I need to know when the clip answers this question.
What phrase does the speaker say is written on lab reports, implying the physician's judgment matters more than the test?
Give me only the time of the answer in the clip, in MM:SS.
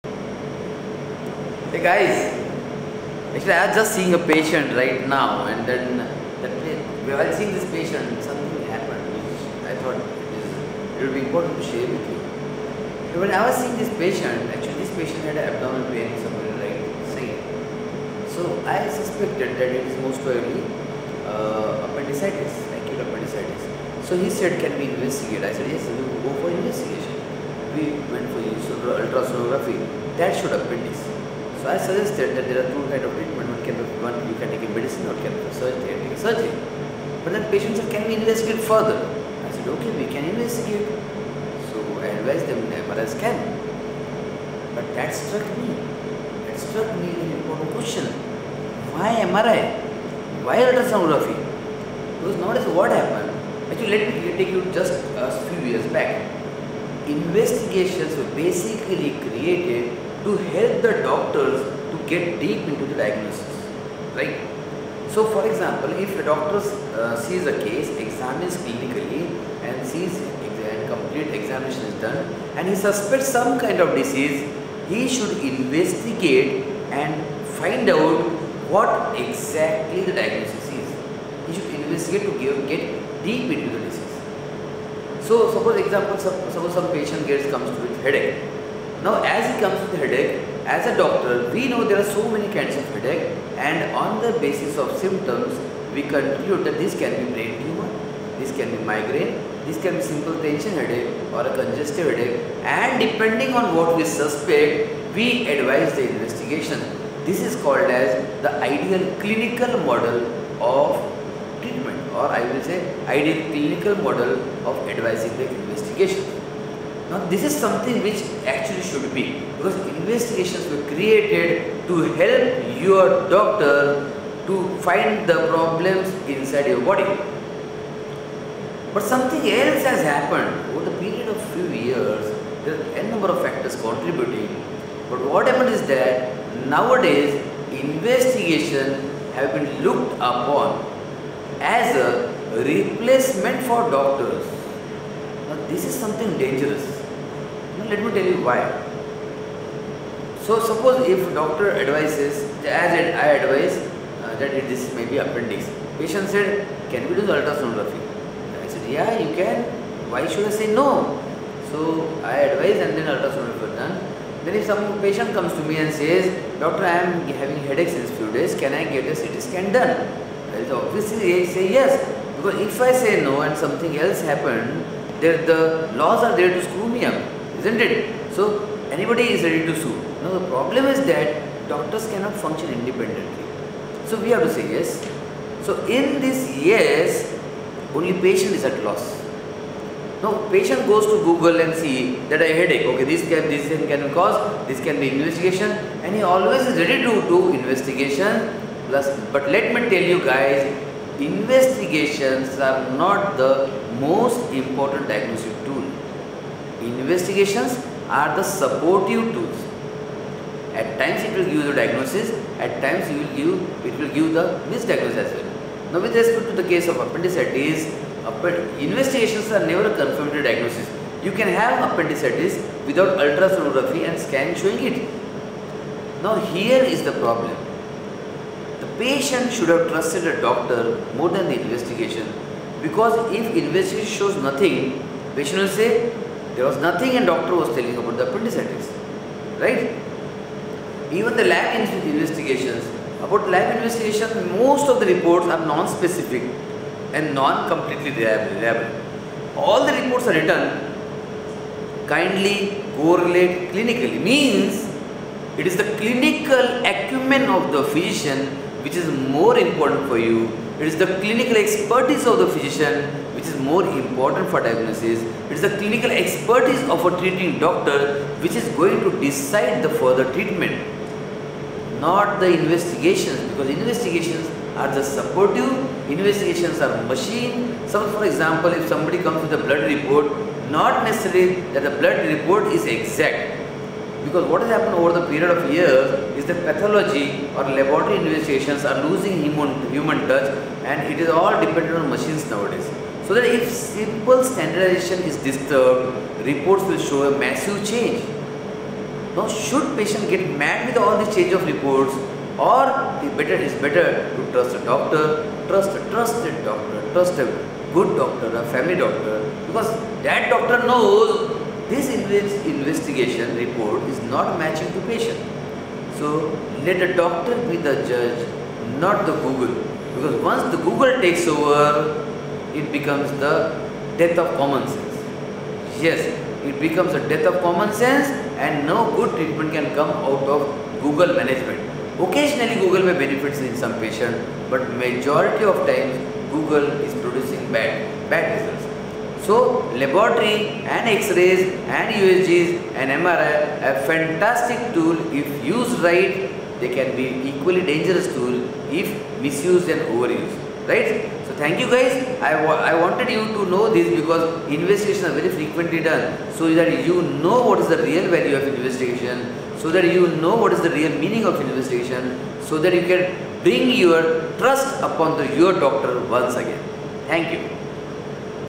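04:12.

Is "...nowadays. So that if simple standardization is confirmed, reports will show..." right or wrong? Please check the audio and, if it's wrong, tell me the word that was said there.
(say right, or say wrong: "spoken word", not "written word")
wrong: "disturbed", not "confirmed".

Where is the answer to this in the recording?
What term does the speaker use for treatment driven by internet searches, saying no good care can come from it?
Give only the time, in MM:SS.
05:31.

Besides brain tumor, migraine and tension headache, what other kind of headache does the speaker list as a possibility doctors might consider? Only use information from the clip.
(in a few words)
Congestive headache.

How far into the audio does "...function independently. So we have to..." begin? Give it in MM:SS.
03:02.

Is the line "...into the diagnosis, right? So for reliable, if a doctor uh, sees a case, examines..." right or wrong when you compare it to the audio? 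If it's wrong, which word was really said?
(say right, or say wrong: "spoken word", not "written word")
wrong: "example", not "reliable".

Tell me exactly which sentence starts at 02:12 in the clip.
There are n number of factors contributing.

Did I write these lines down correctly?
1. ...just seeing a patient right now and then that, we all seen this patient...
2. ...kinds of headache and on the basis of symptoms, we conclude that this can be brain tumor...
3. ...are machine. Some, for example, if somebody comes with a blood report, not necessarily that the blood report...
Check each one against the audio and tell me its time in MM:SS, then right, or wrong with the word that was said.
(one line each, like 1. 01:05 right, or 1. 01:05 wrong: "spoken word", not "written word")
1. 00:03 right
2. 01:32 right
3. 04:36 right.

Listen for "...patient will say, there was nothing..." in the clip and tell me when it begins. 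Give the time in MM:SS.
03:55.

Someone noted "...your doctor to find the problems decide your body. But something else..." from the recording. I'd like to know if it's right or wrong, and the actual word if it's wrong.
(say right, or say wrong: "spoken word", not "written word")
wrong: "inside", not "decide".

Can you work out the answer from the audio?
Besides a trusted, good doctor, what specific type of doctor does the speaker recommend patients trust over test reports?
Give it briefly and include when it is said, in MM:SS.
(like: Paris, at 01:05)
Family doctor, at 05:08.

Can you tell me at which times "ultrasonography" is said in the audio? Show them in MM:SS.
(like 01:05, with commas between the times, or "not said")
00:28, 00:50, 02:37, 02:43, 03:43.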